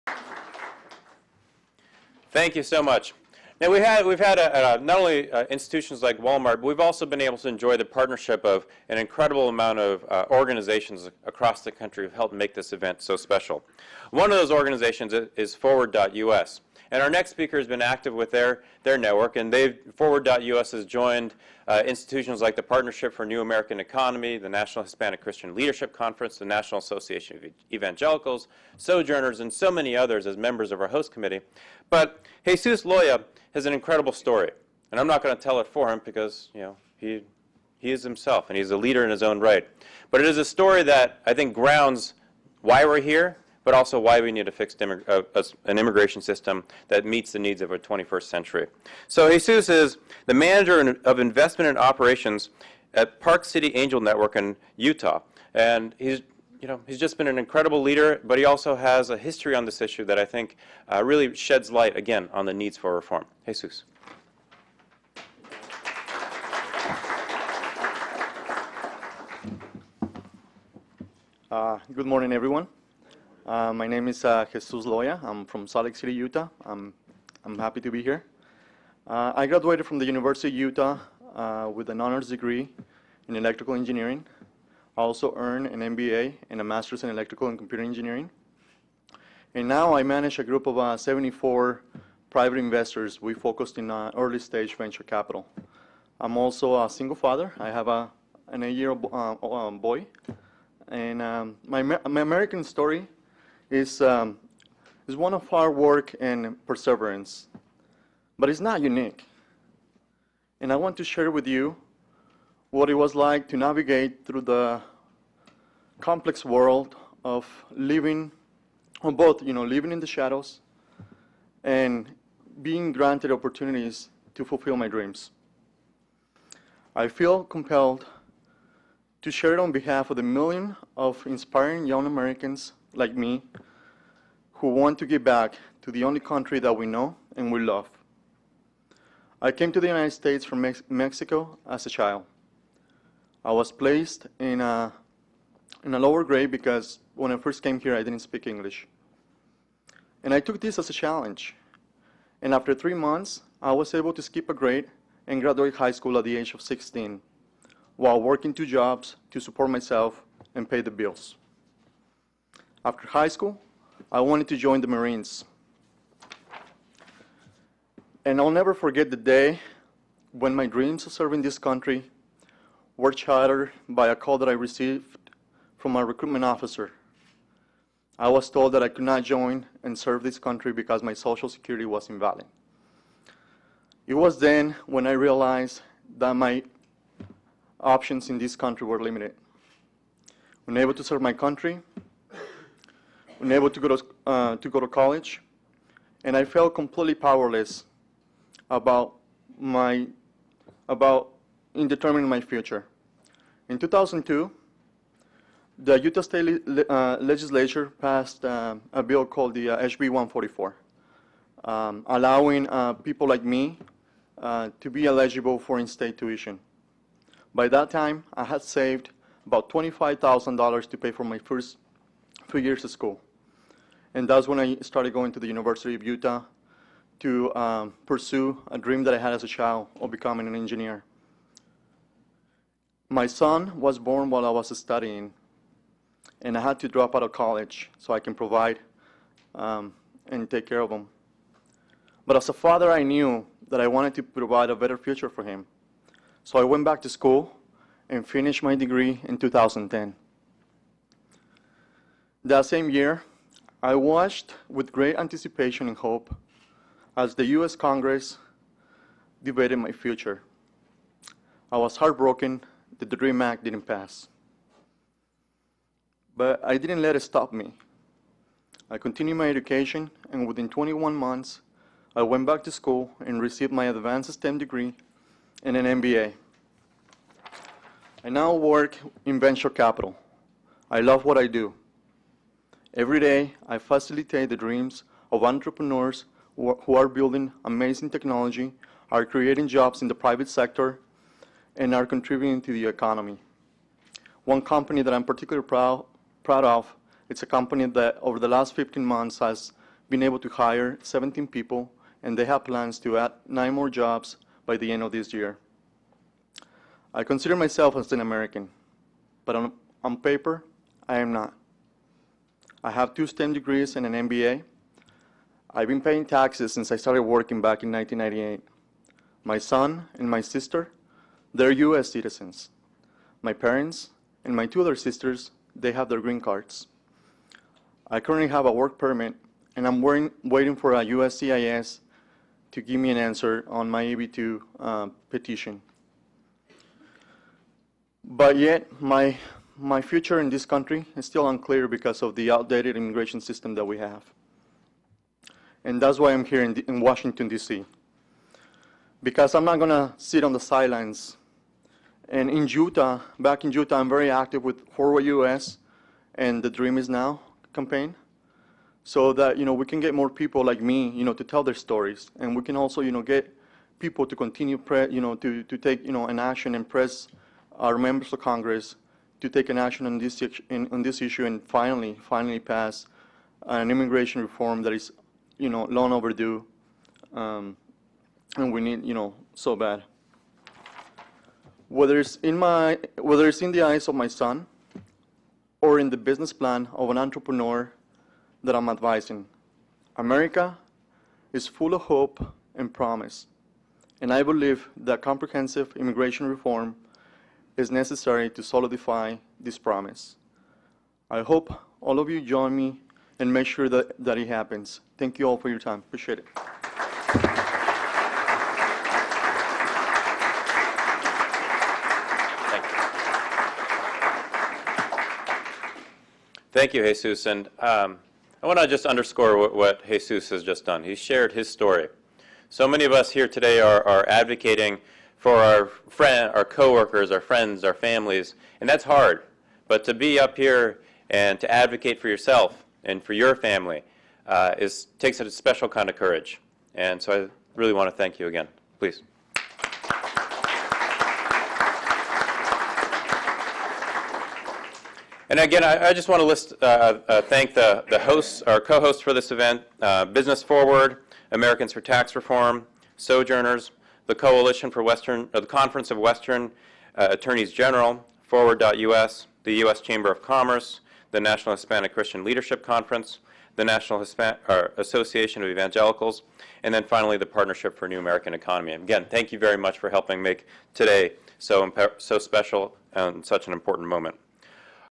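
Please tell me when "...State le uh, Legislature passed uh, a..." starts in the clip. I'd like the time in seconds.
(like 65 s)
206 s.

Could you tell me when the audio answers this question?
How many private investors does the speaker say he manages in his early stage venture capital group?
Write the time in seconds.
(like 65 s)
90 s.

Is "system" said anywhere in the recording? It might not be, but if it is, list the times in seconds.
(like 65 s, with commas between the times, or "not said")
46 s, 343 s.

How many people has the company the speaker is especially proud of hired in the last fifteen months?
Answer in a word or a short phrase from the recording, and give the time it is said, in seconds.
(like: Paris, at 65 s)
17, at 301 s.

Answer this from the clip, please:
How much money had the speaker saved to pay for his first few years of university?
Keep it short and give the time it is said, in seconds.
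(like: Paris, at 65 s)
$25,000, at 219 s.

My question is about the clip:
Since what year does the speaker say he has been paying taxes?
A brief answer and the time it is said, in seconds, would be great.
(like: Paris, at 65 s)
1998, at 317 s.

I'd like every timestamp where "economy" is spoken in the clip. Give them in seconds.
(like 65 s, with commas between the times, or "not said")
23 s, 292 s, 468 s.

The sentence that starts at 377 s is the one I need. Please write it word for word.
Um, and we need, you know, so bad.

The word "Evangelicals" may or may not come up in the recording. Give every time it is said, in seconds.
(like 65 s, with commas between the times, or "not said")
27 s, 465 s.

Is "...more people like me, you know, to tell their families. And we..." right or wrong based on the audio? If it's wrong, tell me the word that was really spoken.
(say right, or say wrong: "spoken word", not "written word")
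wrong: "stories", not "families".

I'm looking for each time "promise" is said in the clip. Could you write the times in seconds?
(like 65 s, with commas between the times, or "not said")
392 s, 399 s.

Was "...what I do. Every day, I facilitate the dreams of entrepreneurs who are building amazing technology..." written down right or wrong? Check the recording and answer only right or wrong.
right.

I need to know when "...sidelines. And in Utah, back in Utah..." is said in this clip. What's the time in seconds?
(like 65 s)
350 s.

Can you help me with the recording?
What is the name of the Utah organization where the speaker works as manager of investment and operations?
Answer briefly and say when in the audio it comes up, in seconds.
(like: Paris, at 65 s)
Park City Angel Network, at 53 s.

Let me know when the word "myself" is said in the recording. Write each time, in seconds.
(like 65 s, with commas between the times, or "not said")
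159 s, 307 s.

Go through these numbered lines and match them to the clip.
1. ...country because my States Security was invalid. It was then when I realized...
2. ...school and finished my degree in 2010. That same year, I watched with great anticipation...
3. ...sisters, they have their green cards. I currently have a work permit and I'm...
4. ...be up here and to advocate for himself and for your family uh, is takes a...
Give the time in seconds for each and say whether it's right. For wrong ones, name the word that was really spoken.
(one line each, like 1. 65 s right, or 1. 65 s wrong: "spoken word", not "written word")
1. 180 s wrong: "Social", not "States"
2. 247 s right
3. 324 s right
4. 430 s wrong: "yourself", not "himself".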